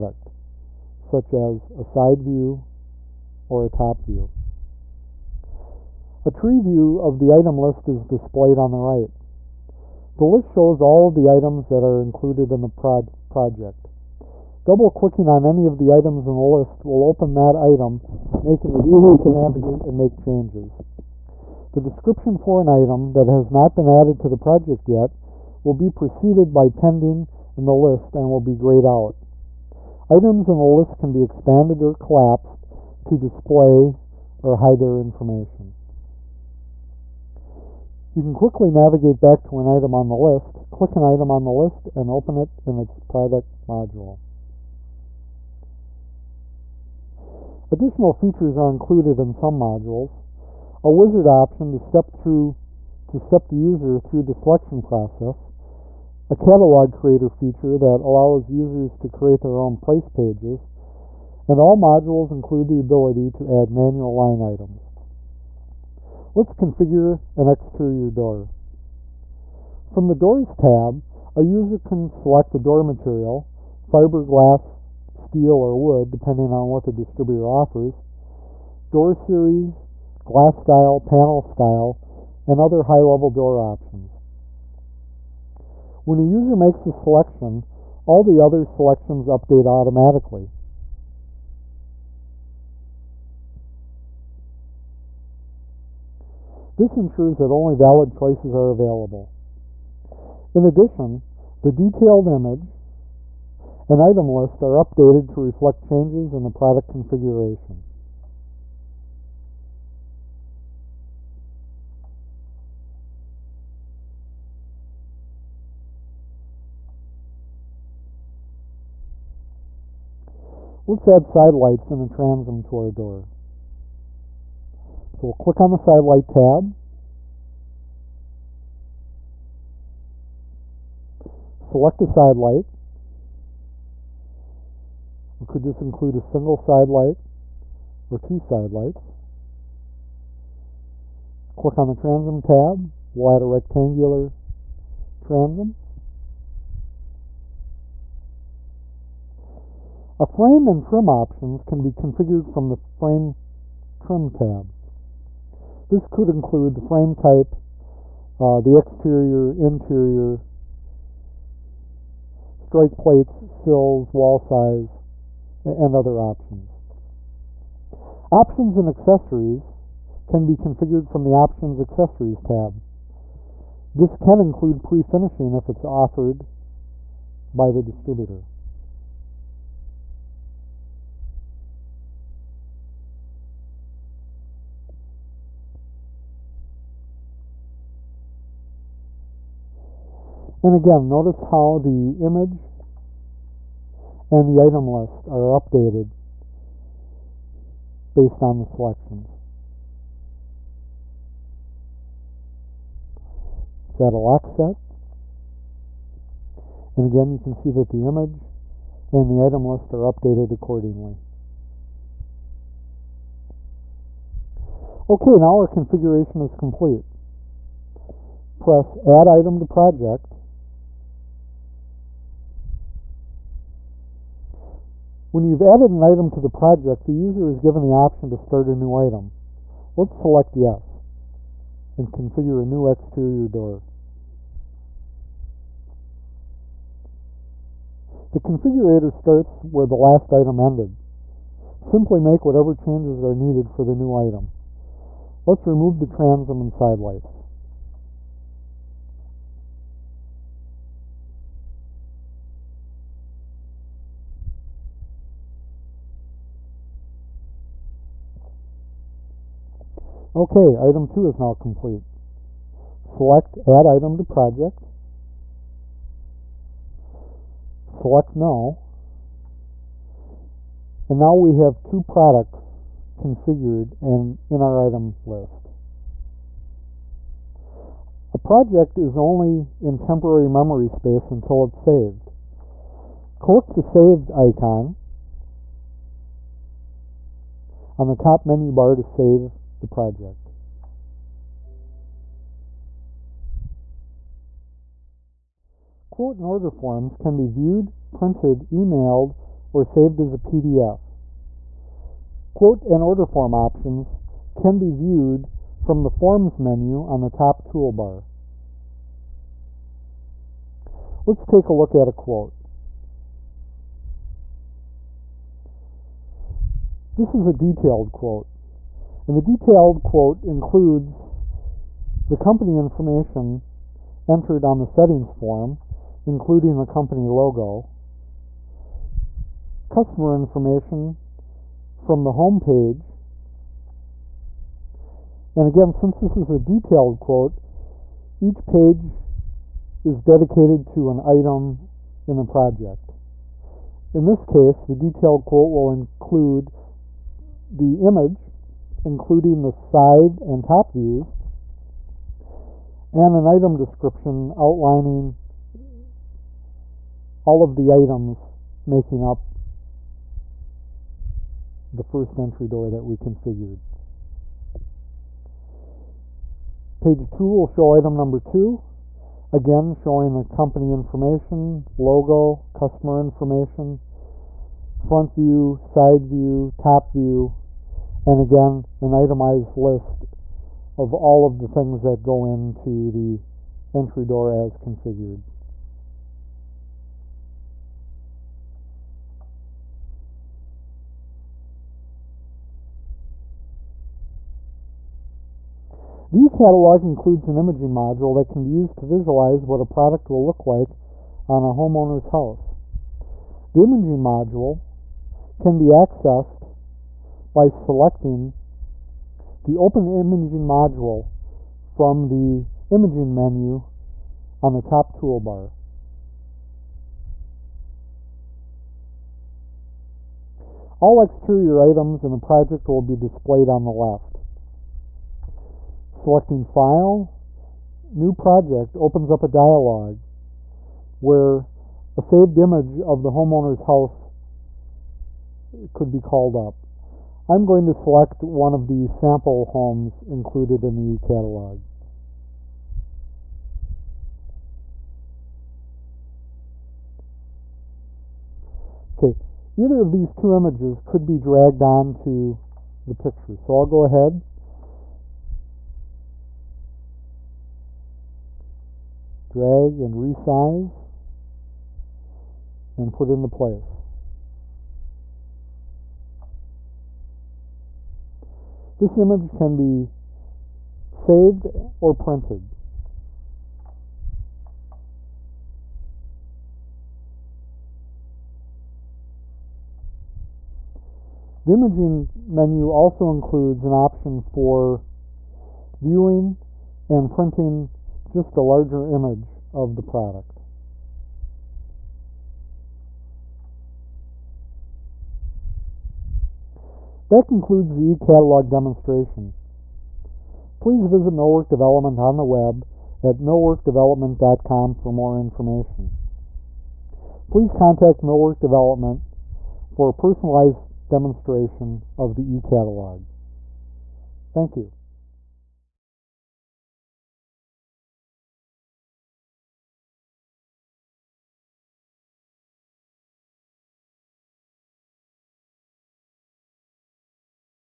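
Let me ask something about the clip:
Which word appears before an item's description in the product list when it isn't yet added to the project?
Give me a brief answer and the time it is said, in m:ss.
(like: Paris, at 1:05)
pending, at 0:26.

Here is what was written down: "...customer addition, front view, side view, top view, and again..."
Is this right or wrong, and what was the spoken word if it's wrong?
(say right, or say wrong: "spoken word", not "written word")
wrong: "information", not "addition".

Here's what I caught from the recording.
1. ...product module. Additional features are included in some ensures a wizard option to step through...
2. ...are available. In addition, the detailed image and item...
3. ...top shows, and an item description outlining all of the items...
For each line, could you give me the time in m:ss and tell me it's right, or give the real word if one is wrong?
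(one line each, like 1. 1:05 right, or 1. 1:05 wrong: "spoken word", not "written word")
1. 0:42 wrong: "modules", not "ensures"
2. 1:38 right
3. 5:50 wrong: "views", not "shows".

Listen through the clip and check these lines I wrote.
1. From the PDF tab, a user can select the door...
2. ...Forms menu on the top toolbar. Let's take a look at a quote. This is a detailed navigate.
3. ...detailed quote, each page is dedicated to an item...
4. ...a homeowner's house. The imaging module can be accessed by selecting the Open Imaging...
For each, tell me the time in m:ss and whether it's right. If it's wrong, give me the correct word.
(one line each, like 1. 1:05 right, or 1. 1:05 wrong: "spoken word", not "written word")
1. 1:09 wrong: "Doors", not "PDF"
2. 5:06 wrong: "quote", not "navigate"
3. 5:36 right
4. 6:41 right.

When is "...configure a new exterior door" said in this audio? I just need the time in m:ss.
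3:52.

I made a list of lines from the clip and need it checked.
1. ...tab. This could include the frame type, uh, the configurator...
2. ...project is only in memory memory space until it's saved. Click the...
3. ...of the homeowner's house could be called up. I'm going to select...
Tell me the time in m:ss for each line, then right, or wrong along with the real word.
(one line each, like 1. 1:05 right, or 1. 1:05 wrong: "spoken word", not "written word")
1. 2:34 wrong: "exterior", not "configurator"
2. 4:38 wrong: "temporary", not "memory"
3. 7:12 right.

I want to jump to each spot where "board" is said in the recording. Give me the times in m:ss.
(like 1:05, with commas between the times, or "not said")
not said.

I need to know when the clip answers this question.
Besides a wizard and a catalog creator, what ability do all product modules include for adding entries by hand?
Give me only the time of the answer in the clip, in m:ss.
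1:03.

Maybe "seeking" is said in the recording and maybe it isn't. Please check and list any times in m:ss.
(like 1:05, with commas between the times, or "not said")
not said.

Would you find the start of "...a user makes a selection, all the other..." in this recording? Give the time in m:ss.
1:26.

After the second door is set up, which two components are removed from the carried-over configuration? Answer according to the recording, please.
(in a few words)
transom and sidelights.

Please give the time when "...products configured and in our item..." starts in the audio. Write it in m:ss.
4:32.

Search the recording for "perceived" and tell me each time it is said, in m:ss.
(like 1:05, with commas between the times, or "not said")
not said.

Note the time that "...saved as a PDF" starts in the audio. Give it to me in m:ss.
4:59.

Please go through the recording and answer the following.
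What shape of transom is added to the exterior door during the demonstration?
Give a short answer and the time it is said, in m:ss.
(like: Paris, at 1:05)
rectangular, at 2:23.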